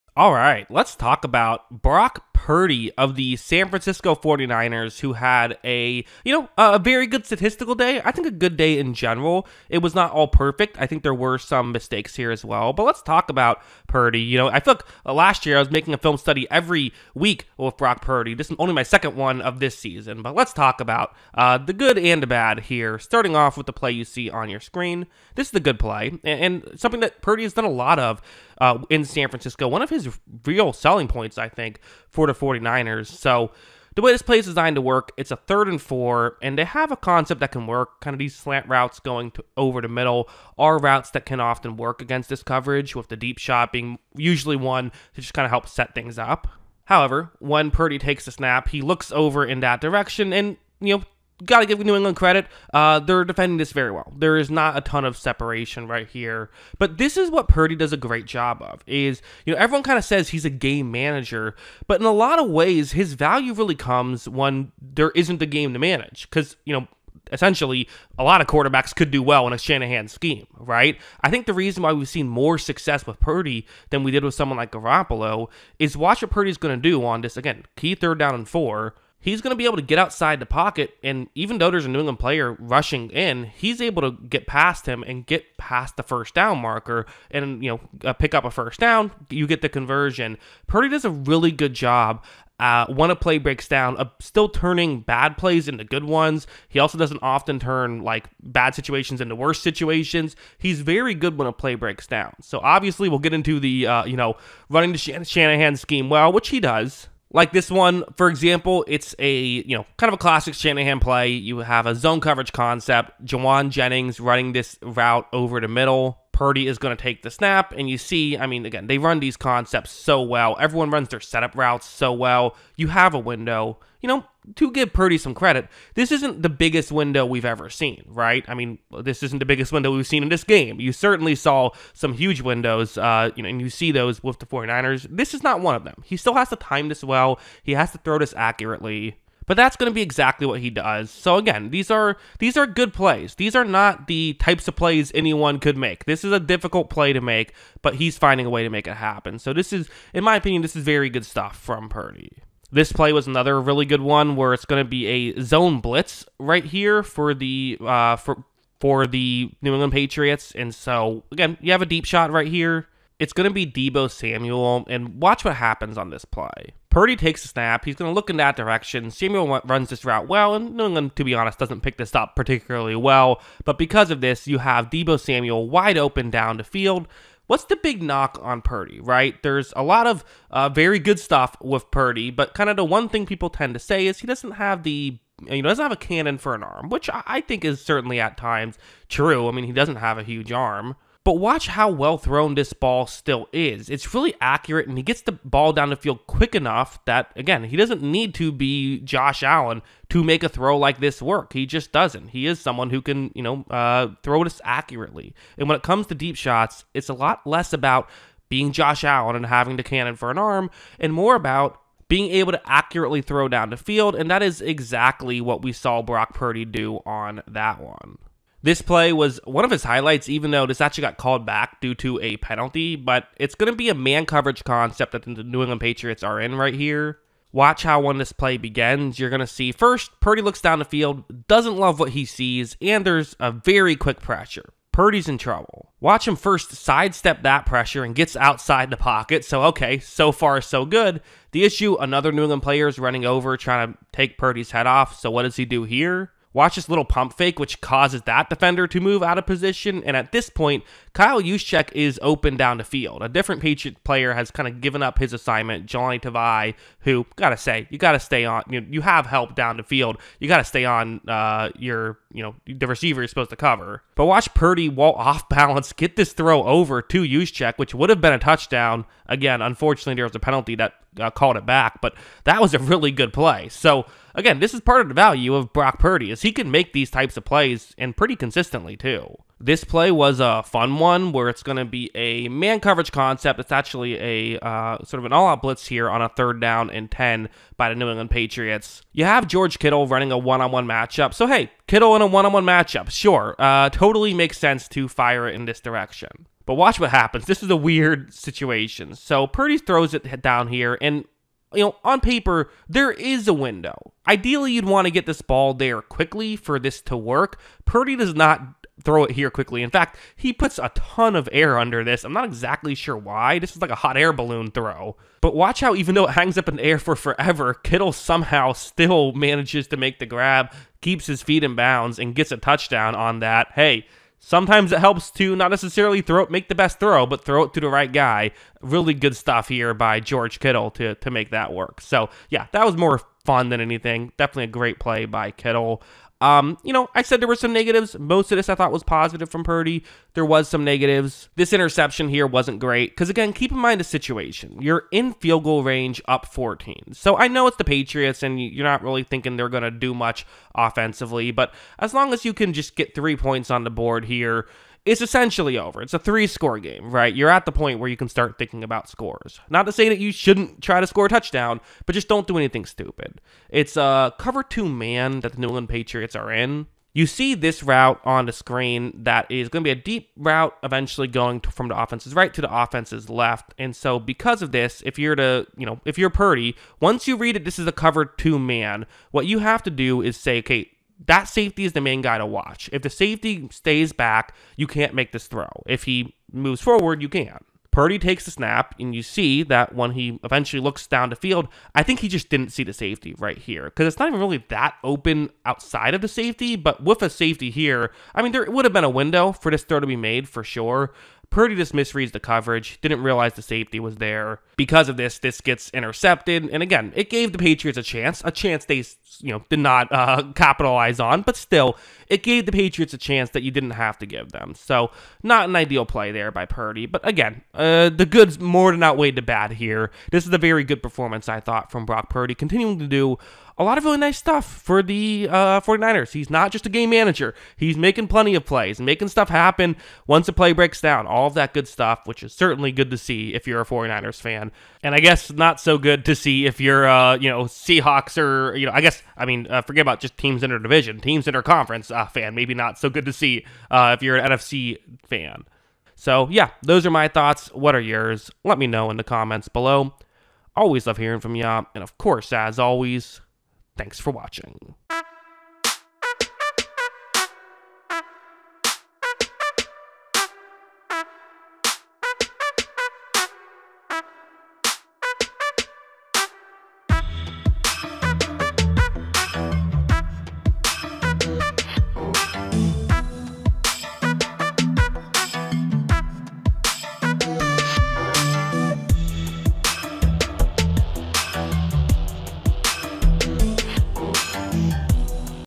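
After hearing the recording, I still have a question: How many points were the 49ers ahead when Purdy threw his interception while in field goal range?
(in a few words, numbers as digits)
14.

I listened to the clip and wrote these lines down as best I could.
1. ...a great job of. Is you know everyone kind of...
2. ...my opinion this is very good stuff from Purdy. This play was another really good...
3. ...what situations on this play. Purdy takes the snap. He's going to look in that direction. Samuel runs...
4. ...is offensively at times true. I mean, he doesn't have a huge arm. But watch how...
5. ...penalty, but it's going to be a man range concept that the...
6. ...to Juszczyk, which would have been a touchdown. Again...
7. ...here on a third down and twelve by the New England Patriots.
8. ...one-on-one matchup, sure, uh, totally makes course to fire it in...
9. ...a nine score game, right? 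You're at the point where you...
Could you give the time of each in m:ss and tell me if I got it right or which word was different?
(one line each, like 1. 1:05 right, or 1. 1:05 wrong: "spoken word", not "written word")
1. 0:57 right
2. 2:30 right
3. 2:45 wrong: "happens", not "situations"
4. 3:07 wrong: "certainly", not "offensively"
5. 3:42 wrong: "coverage", not "range"
6. 4:27 right
7. 4:45 wrong: "ten", not "twelve"
8. 4:52 wrong: "sense", not "course"
9. 5:56 wrong: "three", not "nine".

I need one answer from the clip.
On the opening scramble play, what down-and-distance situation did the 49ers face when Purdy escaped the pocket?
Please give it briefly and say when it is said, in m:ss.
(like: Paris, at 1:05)
Third and four, at 0:35.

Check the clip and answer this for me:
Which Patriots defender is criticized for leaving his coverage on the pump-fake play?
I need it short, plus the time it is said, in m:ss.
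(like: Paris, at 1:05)
Johnny Tavai, at 4:15.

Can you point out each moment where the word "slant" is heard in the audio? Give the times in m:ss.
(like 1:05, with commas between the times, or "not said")
0:38.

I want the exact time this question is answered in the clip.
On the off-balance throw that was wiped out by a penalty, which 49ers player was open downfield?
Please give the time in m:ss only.
4:11.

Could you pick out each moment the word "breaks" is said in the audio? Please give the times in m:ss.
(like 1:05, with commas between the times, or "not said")
1:33, 1:41, 7:10.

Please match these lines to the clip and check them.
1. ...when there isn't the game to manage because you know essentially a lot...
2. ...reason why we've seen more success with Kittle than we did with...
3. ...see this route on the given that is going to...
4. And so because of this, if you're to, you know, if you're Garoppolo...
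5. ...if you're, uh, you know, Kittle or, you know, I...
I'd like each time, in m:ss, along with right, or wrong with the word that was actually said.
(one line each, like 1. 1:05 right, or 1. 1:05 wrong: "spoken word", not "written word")
1. 1:04 right
2. 1:11 wrong: "Purdy", not "Kittle"
3. 6:07 wrong: "screen", not "given"
4. 6:13 wrong: "Purdy", not "Garoppolo"
5. 7:16 wrong: "Seahawks", not "Kittle".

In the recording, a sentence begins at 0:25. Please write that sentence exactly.
This is the good play, and, and something that Purdy has done a lot of uh, in San Francisco.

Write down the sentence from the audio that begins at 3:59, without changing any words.
So, okay, so far, so good.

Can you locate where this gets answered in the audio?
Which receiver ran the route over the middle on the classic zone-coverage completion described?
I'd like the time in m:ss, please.
1:53.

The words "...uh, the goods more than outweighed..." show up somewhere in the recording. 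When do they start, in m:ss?
6:57.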